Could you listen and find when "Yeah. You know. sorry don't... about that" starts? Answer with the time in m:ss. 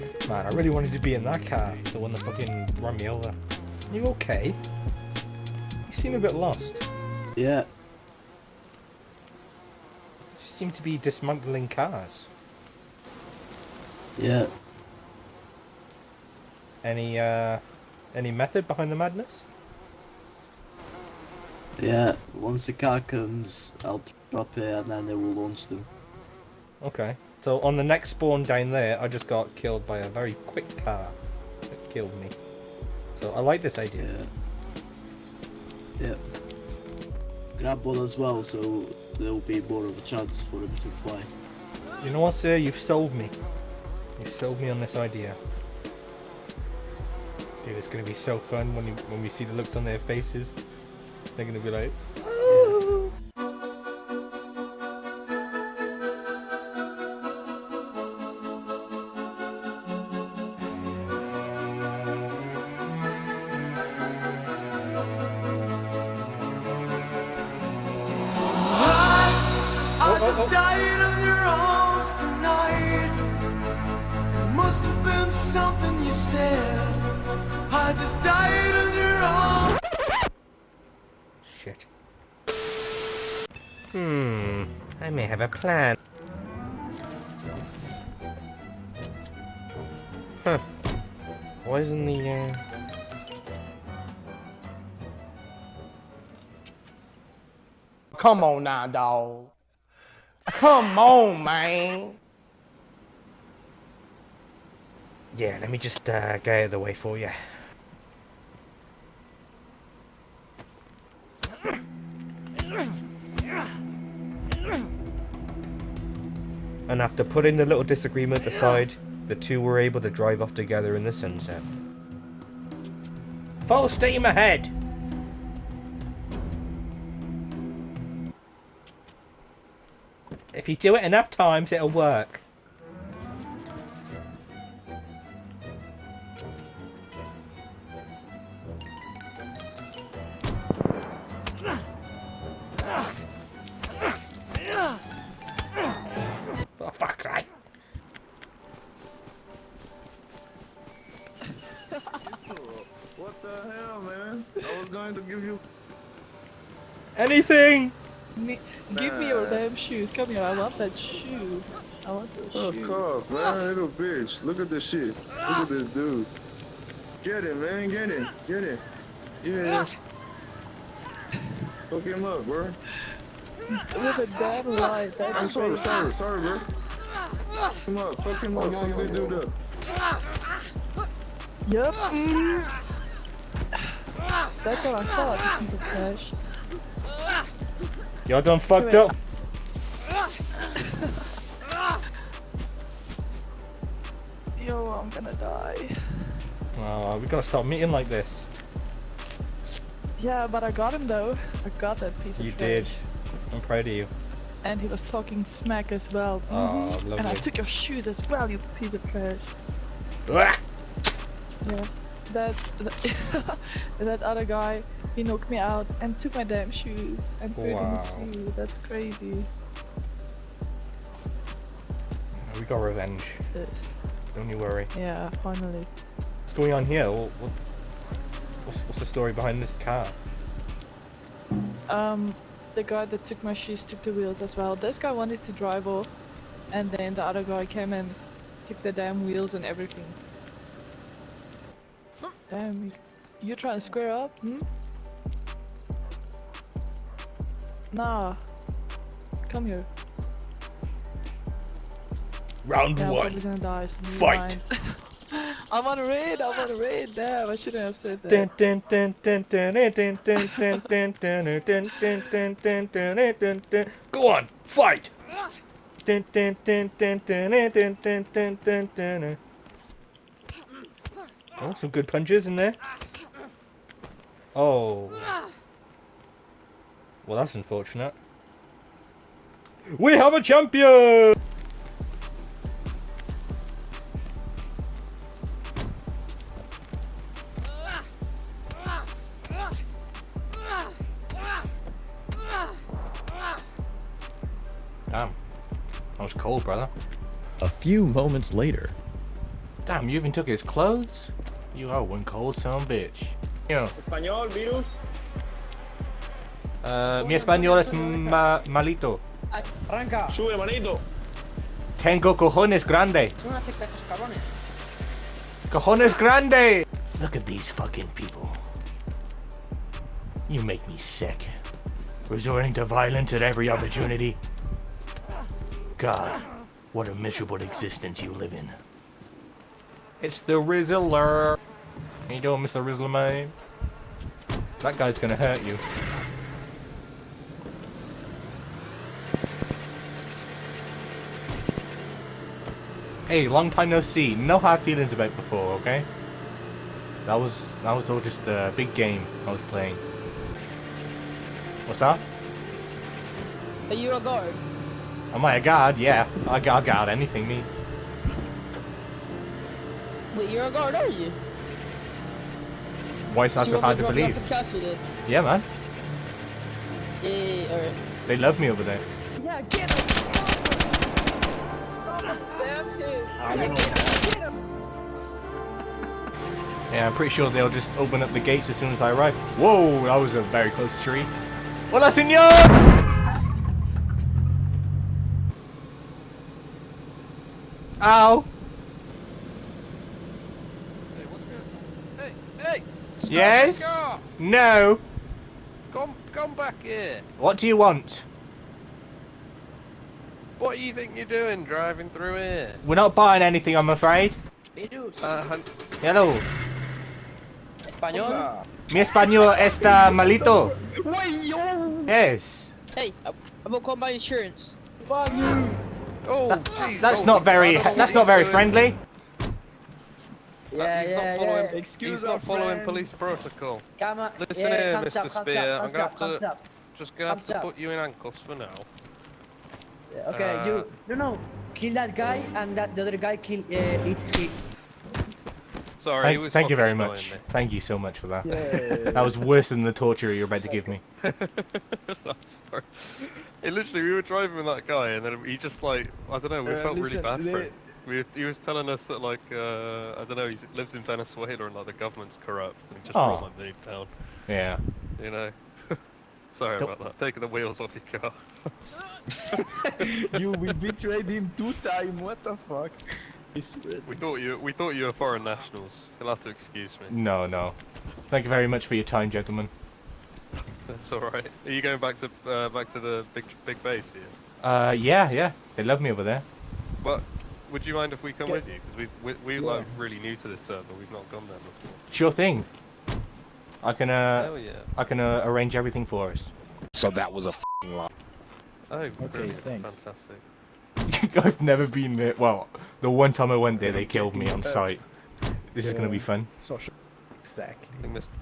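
7:34.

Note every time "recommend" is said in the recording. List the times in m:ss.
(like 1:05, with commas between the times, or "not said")
not said.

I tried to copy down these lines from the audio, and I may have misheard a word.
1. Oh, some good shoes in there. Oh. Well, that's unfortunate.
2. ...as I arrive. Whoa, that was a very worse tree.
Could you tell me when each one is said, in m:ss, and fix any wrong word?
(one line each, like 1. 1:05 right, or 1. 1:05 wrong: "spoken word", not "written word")
1. 4:31 wrong: "punches", not "shoes"
2. 6:18 wrong: "close", not "worse".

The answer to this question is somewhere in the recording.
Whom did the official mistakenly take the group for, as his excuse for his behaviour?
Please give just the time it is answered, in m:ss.
7:45.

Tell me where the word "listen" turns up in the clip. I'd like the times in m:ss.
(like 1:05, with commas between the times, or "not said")
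7:04, 7:26.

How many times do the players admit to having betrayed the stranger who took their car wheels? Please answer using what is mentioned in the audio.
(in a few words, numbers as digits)
2.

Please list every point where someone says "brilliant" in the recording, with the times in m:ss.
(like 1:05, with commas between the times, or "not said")
8:09.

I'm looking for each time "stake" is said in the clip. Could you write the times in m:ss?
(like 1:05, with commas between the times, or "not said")
not said.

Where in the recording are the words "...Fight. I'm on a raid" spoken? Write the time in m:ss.
4:14.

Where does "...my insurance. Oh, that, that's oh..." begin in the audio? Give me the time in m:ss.
6:53.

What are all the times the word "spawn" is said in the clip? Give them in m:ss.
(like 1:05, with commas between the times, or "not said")
0:28.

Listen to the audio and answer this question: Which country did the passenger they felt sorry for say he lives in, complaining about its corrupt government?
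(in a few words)
Venezuela.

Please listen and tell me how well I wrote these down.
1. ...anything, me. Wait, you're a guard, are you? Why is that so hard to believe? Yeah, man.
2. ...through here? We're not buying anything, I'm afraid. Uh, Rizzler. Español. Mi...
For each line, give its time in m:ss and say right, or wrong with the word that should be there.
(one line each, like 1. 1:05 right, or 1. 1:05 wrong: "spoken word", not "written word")
1. 5:57 right
2. 6:42 wrong: "Hello", not "Rizzler".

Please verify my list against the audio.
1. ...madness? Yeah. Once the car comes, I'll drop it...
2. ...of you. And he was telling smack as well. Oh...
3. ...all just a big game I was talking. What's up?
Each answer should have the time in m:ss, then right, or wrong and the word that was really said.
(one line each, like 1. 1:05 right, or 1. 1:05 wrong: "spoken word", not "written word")
1. 0:18 right
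2. 3:23 wrong: "talking", not "telling"
3. 5:48 wrong: "playing", not "talking".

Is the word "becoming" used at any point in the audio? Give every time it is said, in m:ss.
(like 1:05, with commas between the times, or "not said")
not said.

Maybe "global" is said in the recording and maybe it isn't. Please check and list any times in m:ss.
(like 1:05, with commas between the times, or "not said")
not said.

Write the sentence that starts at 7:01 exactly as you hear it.
Excuse He's not following police protocol.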